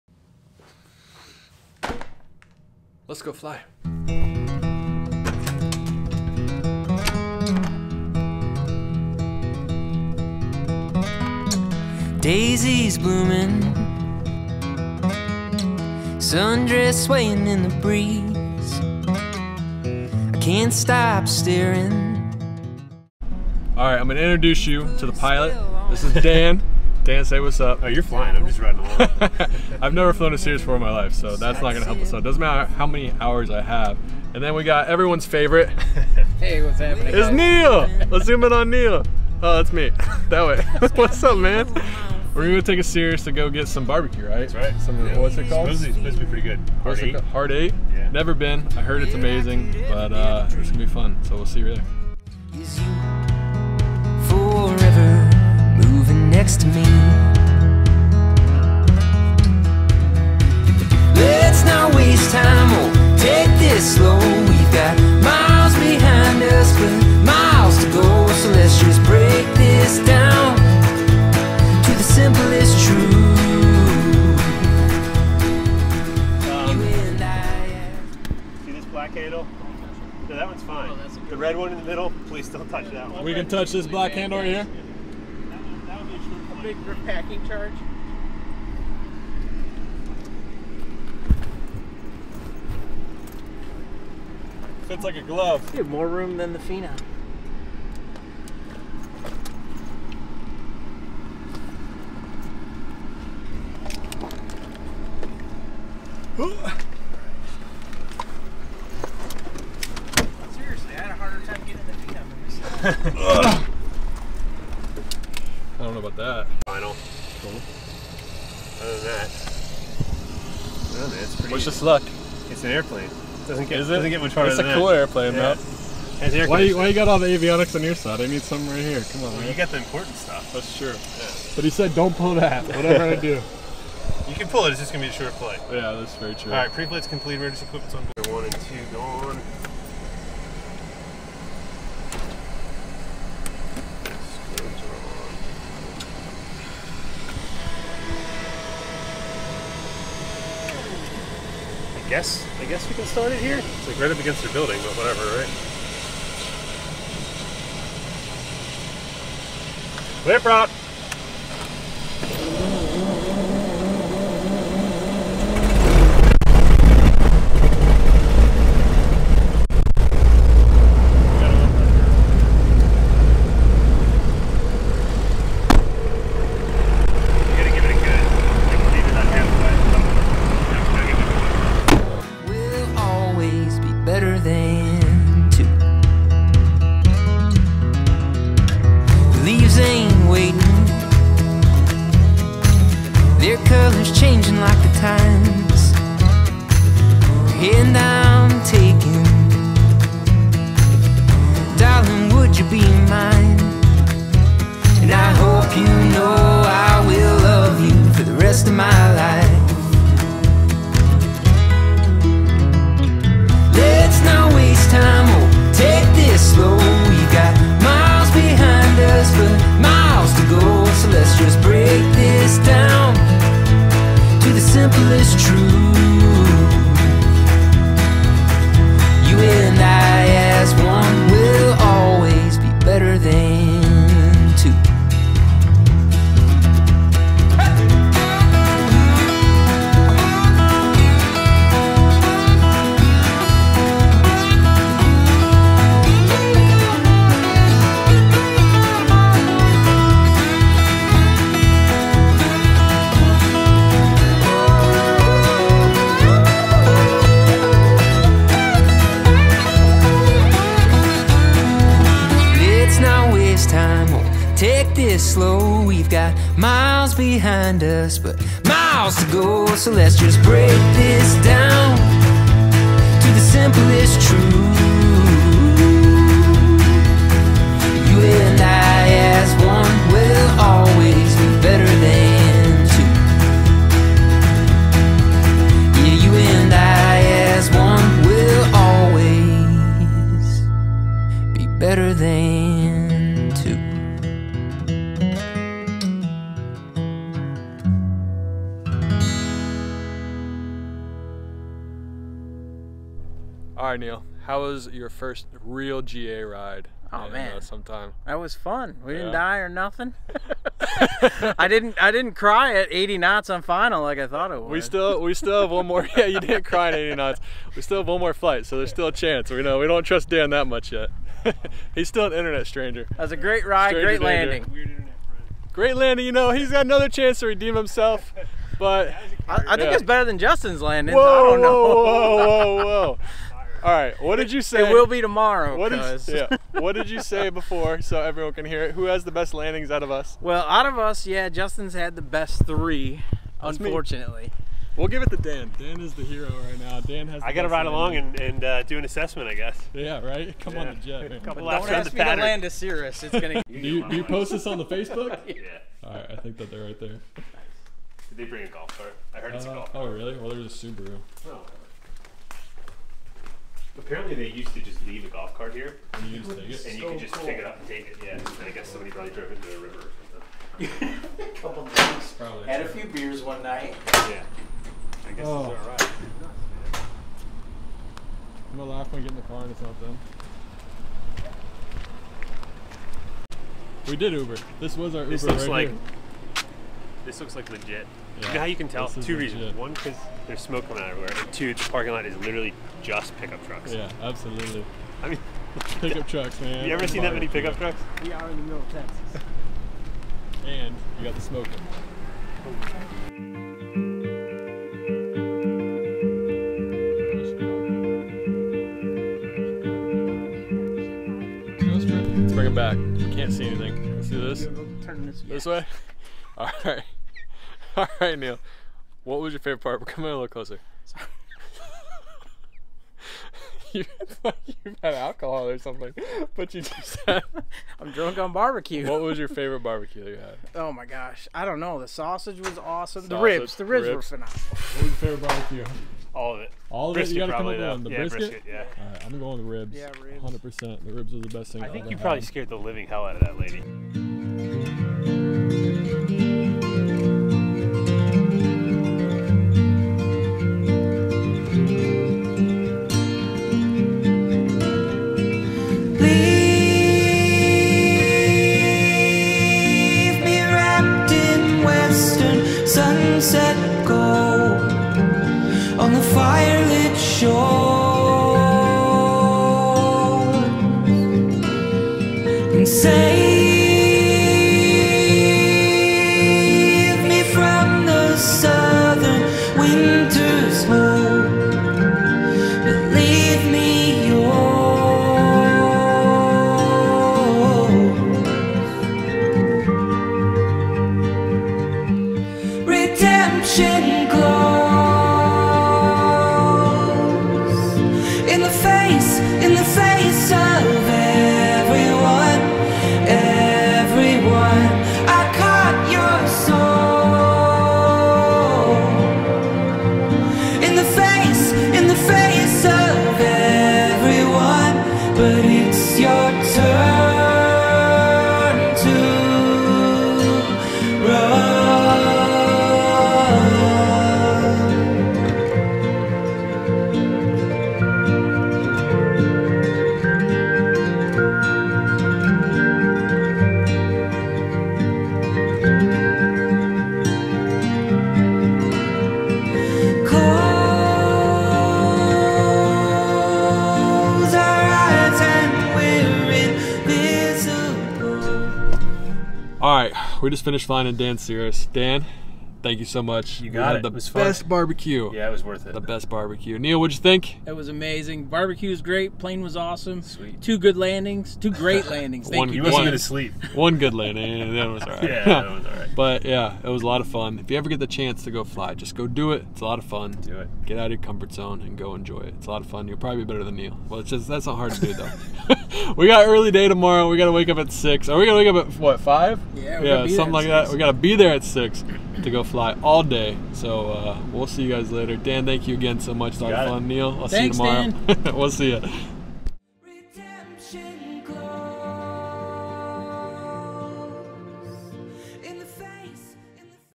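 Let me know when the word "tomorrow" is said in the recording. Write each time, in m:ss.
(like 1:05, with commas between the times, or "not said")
5:35, 9:36, 9:48.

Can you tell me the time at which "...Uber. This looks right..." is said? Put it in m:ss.
6:25.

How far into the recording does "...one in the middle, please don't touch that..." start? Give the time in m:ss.
1:21.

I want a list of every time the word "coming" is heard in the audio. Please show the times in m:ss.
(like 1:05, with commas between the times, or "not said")
6:30, 7:00.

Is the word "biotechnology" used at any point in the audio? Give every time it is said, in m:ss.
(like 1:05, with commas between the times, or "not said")
not said.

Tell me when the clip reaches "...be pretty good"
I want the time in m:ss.
0:46.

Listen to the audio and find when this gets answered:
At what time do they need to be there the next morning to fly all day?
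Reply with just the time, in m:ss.
9:41.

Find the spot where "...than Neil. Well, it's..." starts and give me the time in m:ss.
9:33.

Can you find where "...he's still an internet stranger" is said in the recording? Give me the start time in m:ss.
5:21.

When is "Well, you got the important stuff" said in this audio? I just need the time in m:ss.
2:09.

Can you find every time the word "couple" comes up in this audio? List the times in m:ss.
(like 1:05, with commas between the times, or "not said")
6:11.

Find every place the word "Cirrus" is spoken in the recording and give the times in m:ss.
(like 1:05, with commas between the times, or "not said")
0:30, 0:42, 5:52, 9:11.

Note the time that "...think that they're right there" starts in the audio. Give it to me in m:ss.
5:56.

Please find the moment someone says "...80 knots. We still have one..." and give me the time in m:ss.
5:16.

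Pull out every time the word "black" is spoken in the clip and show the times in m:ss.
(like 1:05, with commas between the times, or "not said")
1:23.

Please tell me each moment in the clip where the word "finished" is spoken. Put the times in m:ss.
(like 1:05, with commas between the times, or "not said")
9:10.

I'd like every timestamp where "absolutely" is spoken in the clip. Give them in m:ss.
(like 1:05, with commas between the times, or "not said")
6:34.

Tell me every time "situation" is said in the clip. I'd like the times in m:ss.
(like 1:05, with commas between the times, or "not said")
not said.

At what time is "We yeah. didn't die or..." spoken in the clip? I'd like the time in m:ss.
5:09.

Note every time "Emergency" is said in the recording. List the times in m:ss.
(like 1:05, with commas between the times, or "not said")
2:17.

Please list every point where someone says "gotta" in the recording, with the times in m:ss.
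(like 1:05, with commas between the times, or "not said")
7:17.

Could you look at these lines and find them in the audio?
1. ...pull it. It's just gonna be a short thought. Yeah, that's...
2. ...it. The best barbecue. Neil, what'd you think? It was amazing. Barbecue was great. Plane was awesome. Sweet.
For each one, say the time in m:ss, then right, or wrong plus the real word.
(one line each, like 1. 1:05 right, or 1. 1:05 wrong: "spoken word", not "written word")
1. 2:14 wrong: "flight", not "thought"
2. 9:15 right.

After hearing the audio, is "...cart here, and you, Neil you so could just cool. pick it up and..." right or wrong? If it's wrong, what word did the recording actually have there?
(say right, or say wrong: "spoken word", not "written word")
wrong: "And", not "Neil".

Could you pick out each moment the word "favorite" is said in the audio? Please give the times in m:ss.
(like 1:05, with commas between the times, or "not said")
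0:35, 6:59, 7:09, 7:15.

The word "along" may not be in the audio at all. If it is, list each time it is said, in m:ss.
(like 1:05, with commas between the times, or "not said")
0:28, 5:47.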